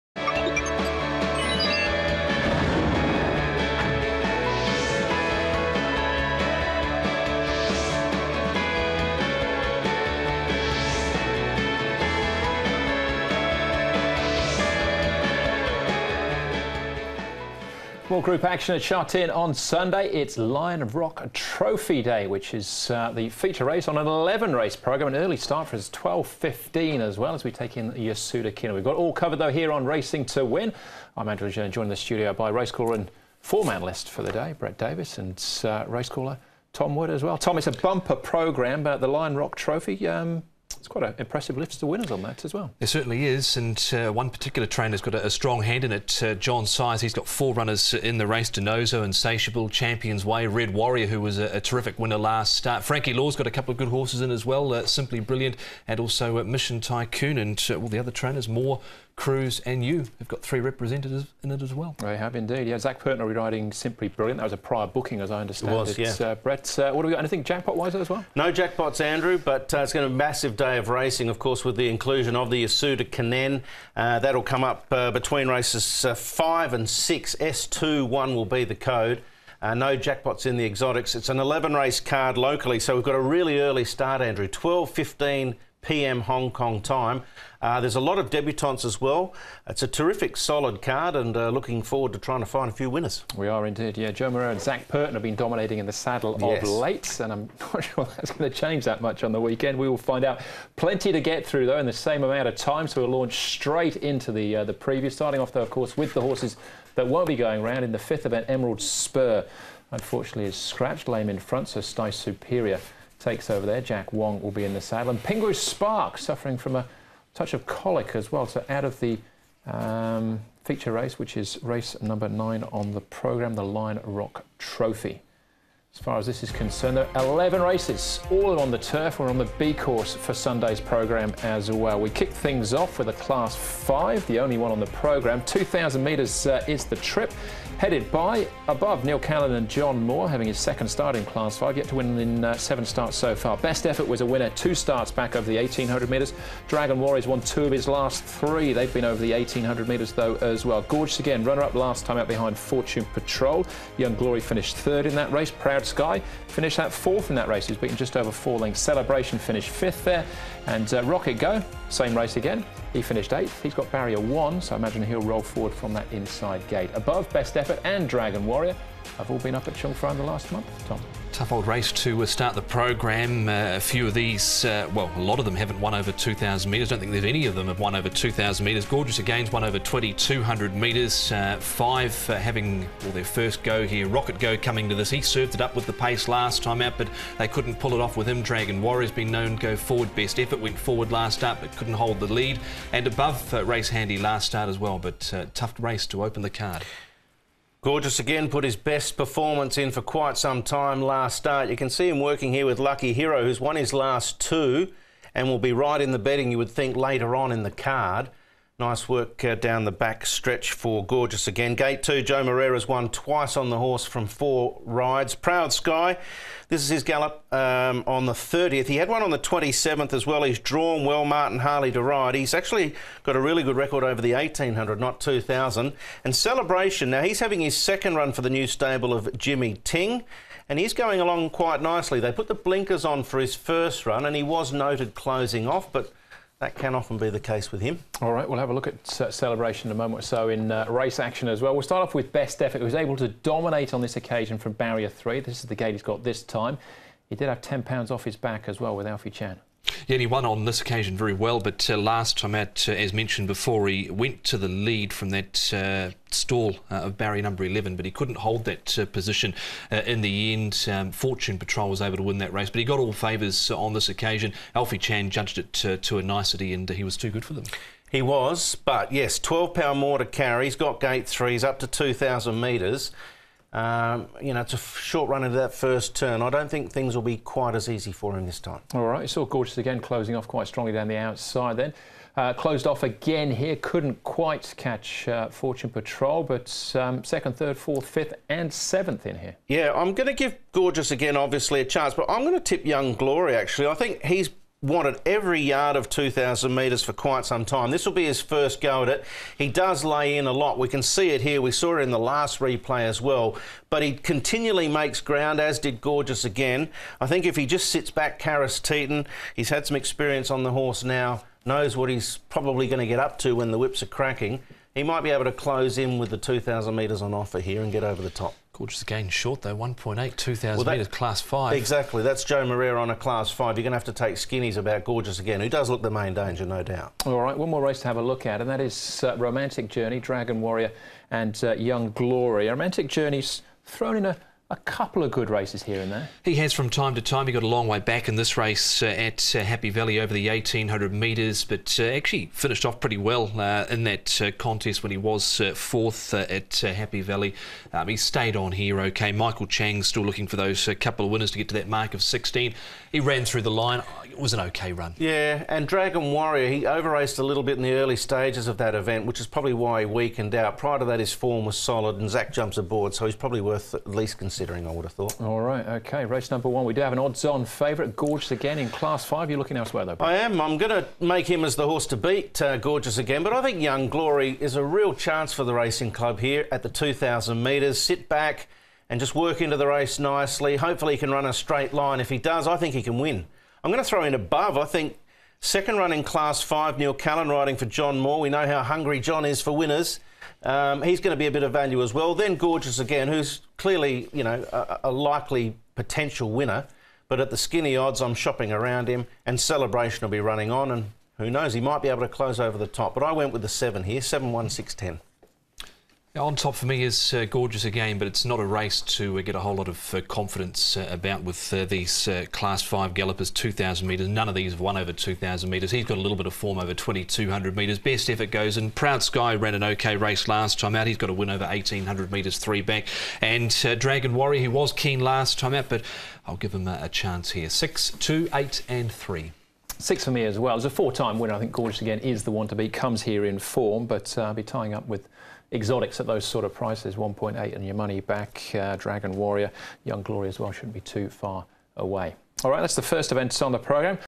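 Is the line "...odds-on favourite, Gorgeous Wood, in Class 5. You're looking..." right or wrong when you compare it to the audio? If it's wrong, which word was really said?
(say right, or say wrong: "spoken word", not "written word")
wrong: "Again", not "Wood".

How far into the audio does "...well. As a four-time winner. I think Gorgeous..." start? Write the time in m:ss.
7:10.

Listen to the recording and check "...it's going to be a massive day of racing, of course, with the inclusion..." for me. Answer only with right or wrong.
right.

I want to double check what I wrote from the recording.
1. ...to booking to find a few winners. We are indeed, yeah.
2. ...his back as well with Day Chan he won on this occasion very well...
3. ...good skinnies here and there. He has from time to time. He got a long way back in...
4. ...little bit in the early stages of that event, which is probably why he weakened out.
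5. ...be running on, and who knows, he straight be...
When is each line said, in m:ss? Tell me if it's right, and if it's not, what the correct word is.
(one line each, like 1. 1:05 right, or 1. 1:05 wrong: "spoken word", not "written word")
1. 1:32 wrong: "trying", not "booking"
2. 4:08 wrong: "Alfie", not "Day"
3. 5:35 wrong: "races", not "skinnies"
4. 5:57 right
5. 6:40 wrong: "might", not "straight".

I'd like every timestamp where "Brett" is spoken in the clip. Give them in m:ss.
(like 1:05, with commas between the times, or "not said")
0:34, 1:06.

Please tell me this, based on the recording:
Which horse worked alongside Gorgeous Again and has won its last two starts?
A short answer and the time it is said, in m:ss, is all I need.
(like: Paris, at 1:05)
Lucky Hero, at 3:22.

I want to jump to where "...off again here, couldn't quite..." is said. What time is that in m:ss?
4:42.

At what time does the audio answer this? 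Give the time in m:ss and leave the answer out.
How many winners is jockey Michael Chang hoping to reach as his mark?
5:52.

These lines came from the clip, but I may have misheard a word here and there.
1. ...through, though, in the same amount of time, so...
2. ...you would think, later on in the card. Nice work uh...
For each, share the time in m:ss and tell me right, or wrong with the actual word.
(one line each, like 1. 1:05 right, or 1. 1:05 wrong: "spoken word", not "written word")
1. 1:41 right
2. 3:26 right.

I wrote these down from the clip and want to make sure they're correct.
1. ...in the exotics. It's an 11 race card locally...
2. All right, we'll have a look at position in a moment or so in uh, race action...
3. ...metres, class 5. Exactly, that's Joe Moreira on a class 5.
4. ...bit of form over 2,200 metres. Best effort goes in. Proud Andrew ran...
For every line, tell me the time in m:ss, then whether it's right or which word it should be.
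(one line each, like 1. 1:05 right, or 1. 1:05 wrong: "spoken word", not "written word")
1. 1:20 right
2. 3:58 wrong: "celebration", not "position"
3. 5:20 right
4. 6:56 wrong: "Sky", not "Andrew".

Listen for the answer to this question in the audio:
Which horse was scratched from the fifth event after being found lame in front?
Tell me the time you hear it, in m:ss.
1:48.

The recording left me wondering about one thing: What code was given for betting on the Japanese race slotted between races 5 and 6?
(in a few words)
S21.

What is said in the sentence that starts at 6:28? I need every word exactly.
We know how hungry John is for winners.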